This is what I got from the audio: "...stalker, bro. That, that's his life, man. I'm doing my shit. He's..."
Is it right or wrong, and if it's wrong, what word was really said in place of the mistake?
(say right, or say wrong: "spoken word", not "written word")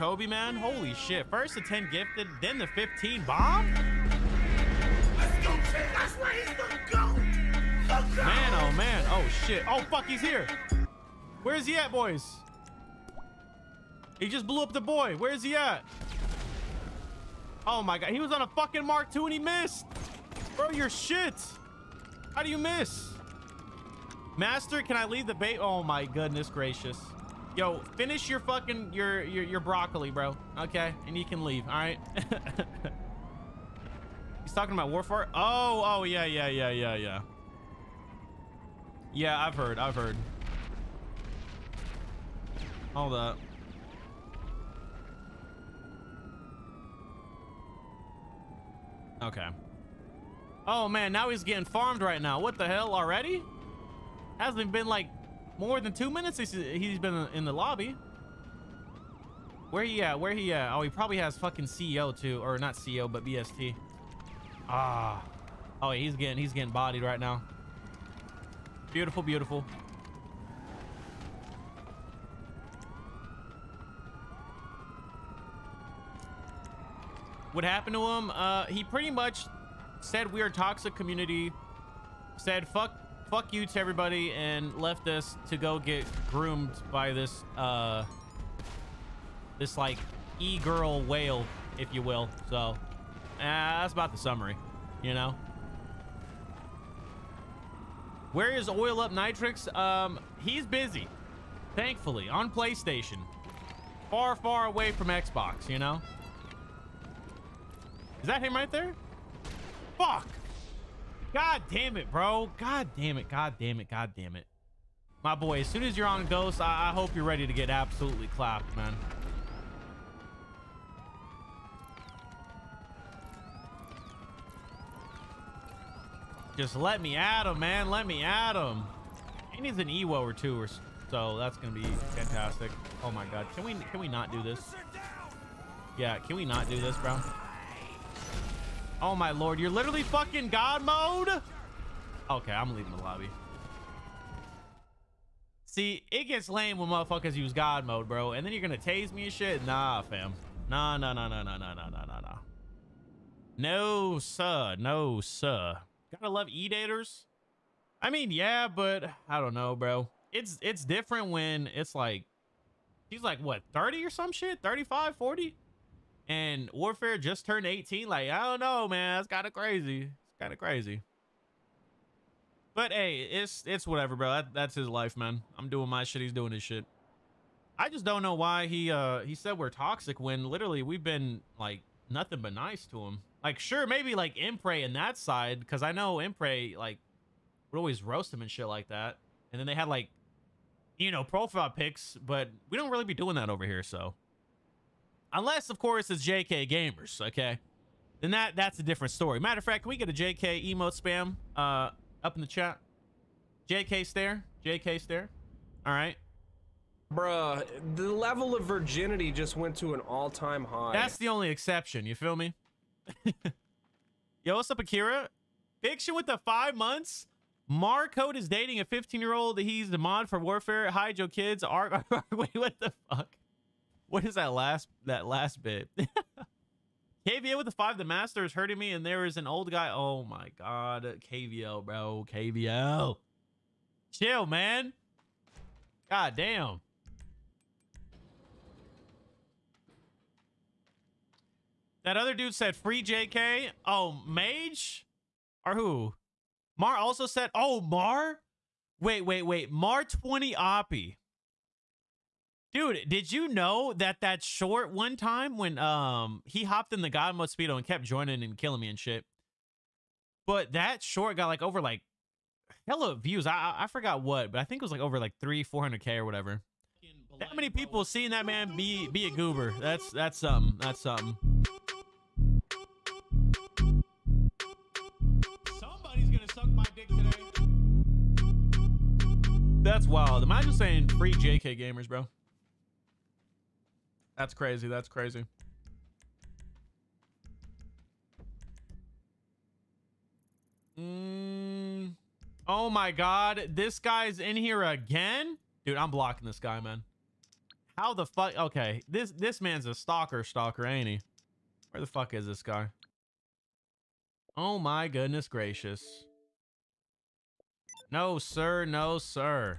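wrong: "whatever", not "stalker".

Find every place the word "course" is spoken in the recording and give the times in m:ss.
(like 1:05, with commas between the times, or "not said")
3:15.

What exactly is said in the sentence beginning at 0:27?
Yo, finish your fucking your your, your broccoli, bro.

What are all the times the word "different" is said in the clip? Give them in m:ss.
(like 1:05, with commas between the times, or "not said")
2:40, 3:18.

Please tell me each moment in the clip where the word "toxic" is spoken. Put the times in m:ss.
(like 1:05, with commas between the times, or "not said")
1:20, 2:59.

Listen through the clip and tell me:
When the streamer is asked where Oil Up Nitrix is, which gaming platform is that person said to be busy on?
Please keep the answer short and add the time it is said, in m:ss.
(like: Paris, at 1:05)
PlayStation, at 1:42.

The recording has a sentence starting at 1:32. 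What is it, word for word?
So, uh, that's about the summary, you know?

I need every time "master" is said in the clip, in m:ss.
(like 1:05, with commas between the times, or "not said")
0:24, 3:48.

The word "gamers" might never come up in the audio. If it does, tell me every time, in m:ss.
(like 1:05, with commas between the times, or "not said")
3:16, 4:41.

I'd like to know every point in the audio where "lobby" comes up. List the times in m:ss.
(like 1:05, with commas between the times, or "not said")
0:57, 2:23.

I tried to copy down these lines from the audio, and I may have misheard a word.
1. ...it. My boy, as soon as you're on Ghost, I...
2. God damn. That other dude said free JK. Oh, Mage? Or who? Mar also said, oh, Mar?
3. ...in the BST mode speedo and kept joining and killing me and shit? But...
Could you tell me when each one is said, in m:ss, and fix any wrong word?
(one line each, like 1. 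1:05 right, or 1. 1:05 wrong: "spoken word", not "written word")
1. 1:54 right
2. 3:56 right
3. 4:16 wrong: "God", not "BST".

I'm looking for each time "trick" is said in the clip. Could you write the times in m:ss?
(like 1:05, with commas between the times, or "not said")
not said.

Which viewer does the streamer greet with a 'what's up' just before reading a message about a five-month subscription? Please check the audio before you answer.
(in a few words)
Akira.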